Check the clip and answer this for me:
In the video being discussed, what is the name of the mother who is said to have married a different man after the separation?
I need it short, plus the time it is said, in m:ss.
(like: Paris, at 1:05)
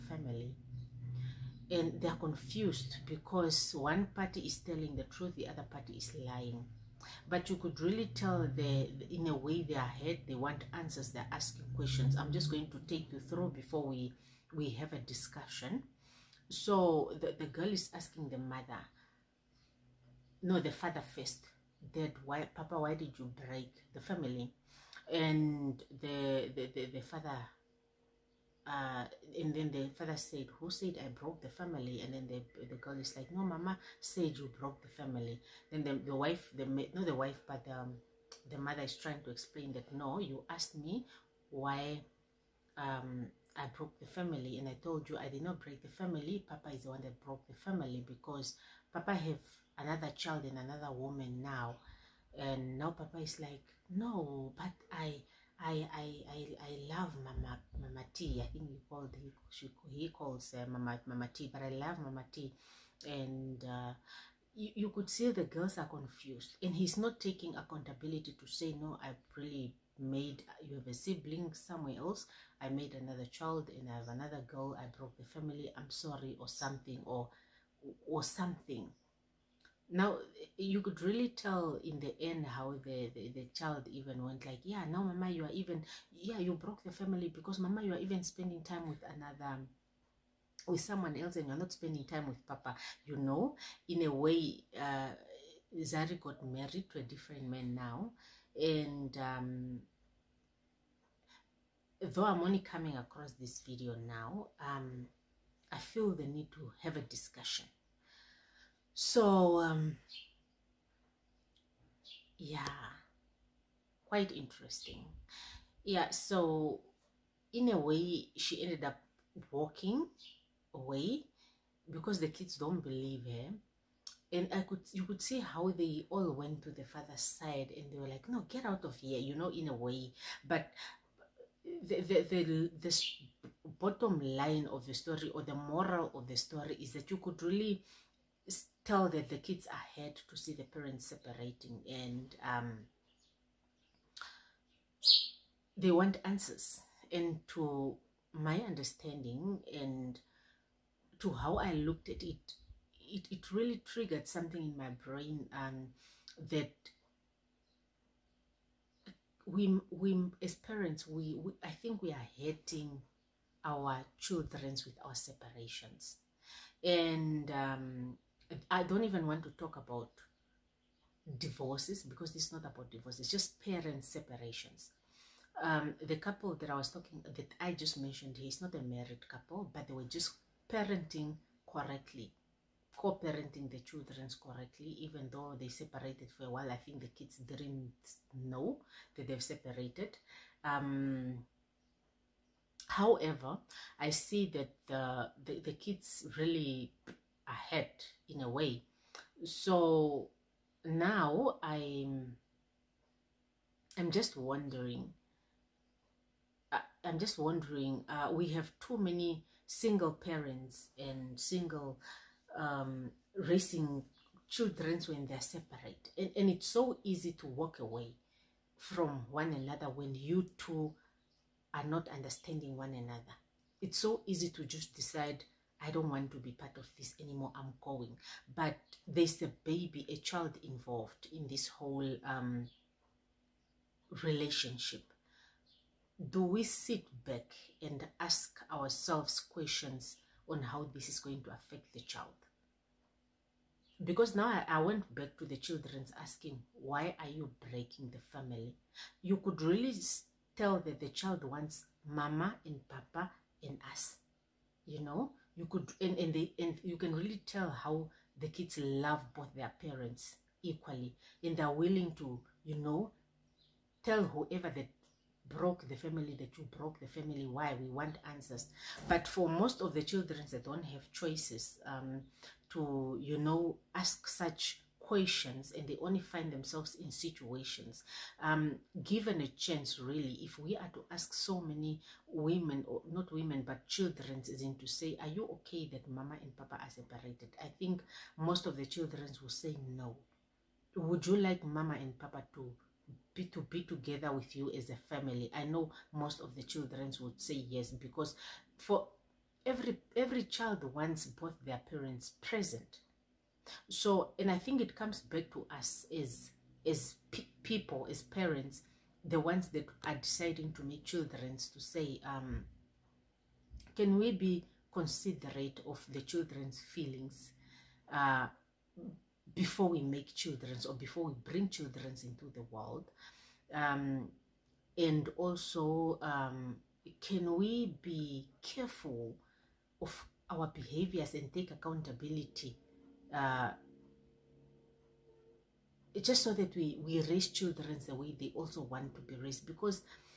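Zari, at 1:35.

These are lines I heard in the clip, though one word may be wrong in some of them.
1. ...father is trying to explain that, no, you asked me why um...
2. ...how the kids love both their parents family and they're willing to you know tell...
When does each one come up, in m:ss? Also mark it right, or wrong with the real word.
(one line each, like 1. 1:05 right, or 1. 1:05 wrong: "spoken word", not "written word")
1. 0:38 wrong: "mother", not "father"
2. 4:17 wrong: "equally", not "family".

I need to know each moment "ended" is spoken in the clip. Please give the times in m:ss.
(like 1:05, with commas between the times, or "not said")
1:58.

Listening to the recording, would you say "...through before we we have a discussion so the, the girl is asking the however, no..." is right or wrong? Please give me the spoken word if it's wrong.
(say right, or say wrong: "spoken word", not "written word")
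wrong: "mother", not "however".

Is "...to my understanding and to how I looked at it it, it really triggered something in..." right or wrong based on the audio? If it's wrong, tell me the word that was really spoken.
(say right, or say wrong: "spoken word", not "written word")
right.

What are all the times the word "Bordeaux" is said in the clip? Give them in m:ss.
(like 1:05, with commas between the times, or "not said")
not said.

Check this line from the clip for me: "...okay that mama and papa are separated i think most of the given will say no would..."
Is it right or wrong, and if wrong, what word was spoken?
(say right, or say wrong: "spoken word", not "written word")
wrong: "children", not "given".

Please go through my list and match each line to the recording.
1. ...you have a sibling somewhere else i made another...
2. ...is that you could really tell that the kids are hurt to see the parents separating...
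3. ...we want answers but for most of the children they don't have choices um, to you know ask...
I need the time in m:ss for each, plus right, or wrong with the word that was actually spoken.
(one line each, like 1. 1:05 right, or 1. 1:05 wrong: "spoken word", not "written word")
1. 1:10 right
2. 2:16 right
3. 4:27 right.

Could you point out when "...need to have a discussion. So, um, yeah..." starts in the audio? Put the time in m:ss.
1:46.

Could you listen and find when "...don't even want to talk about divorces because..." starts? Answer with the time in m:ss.
2:48.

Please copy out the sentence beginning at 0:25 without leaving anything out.
And the, the, the, the father uh, and then the father said, who said I broke the family?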